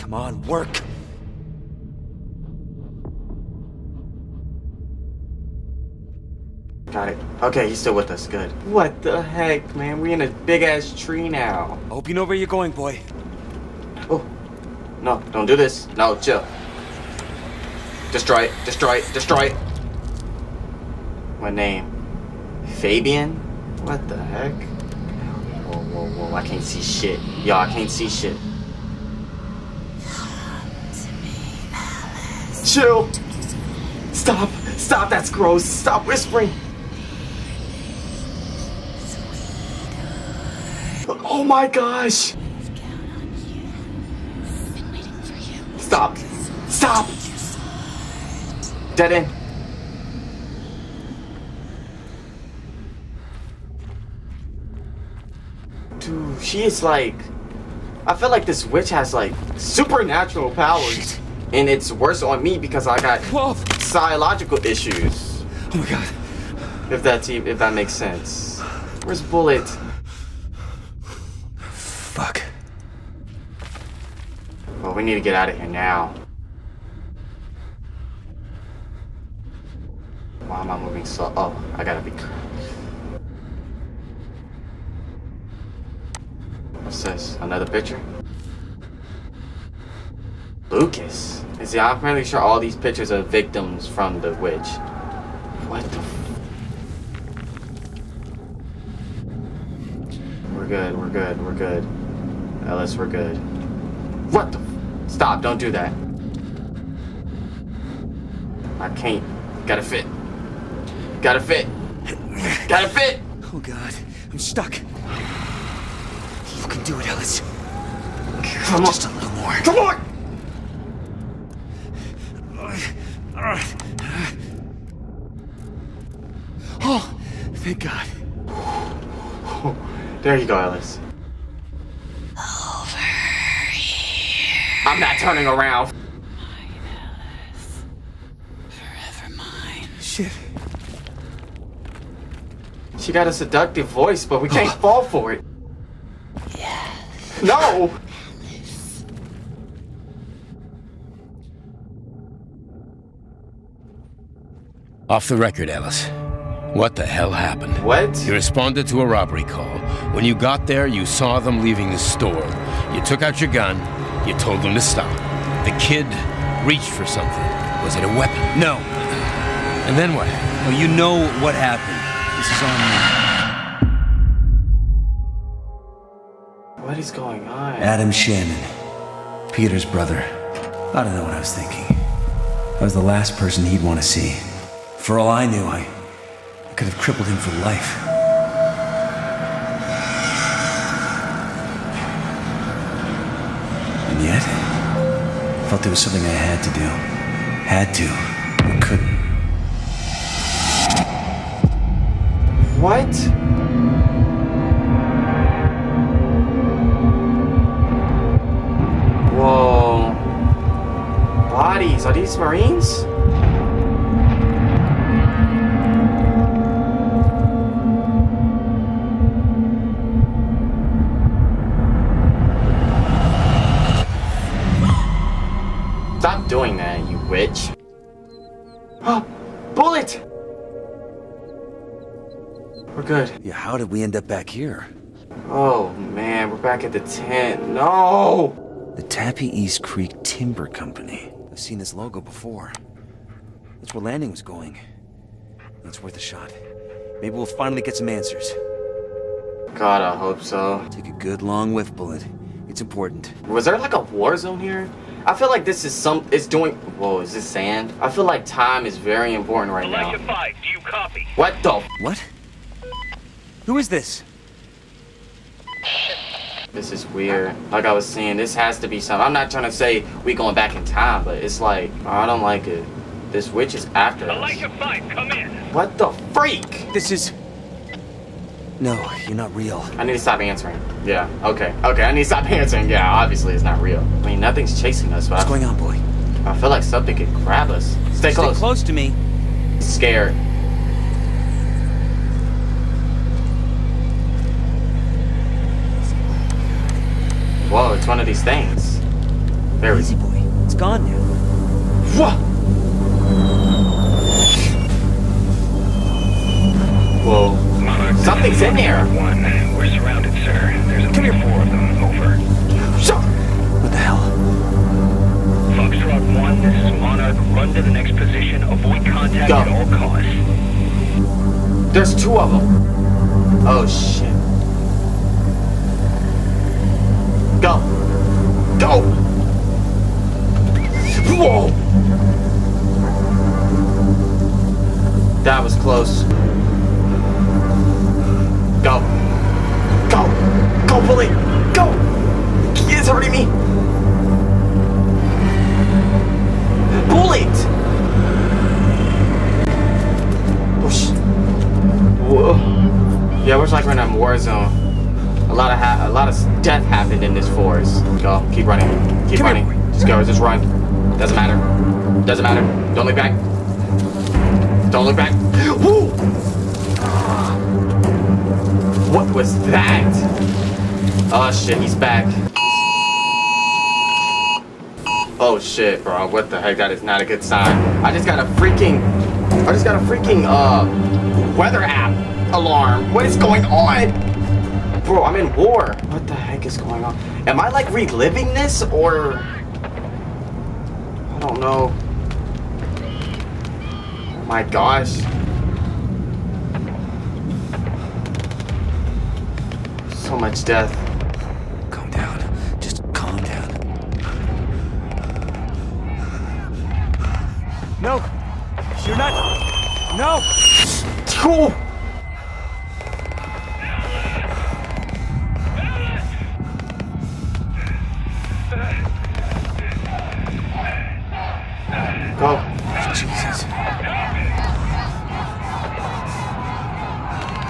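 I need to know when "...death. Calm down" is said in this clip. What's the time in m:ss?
6:40.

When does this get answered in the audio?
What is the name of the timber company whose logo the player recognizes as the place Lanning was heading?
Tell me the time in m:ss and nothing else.
3:58.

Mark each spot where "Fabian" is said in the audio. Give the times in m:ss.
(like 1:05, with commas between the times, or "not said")
0:22.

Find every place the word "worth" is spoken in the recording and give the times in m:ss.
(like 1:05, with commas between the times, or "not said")
4:06.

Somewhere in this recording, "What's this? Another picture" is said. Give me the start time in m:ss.
1:26.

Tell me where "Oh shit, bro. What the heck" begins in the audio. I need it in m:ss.
6:15.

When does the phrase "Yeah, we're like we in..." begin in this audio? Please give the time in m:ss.
5:53.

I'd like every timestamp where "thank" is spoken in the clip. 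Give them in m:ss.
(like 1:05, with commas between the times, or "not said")
2:07.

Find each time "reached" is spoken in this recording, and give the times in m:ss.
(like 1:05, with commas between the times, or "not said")
2:46.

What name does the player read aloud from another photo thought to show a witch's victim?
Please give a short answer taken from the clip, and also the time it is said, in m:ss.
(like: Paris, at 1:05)
Lucas, at 1:30.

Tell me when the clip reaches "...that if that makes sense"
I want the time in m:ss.
1:07.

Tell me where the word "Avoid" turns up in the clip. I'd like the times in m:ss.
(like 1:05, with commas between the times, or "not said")
5:18.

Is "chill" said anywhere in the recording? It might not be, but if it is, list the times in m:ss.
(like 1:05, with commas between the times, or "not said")
0:16, 0:32.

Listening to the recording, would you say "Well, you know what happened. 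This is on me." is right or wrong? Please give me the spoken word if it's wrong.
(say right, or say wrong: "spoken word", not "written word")
right.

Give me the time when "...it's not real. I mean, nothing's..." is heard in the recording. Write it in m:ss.
4:43.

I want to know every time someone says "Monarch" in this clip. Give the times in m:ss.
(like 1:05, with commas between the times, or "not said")
5:16.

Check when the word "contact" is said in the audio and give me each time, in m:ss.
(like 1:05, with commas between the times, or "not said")
5:19.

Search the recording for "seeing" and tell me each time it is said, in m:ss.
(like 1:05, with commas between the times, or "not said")
not said.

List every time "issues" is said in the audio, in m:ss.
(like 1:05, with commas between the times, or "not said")
1:04.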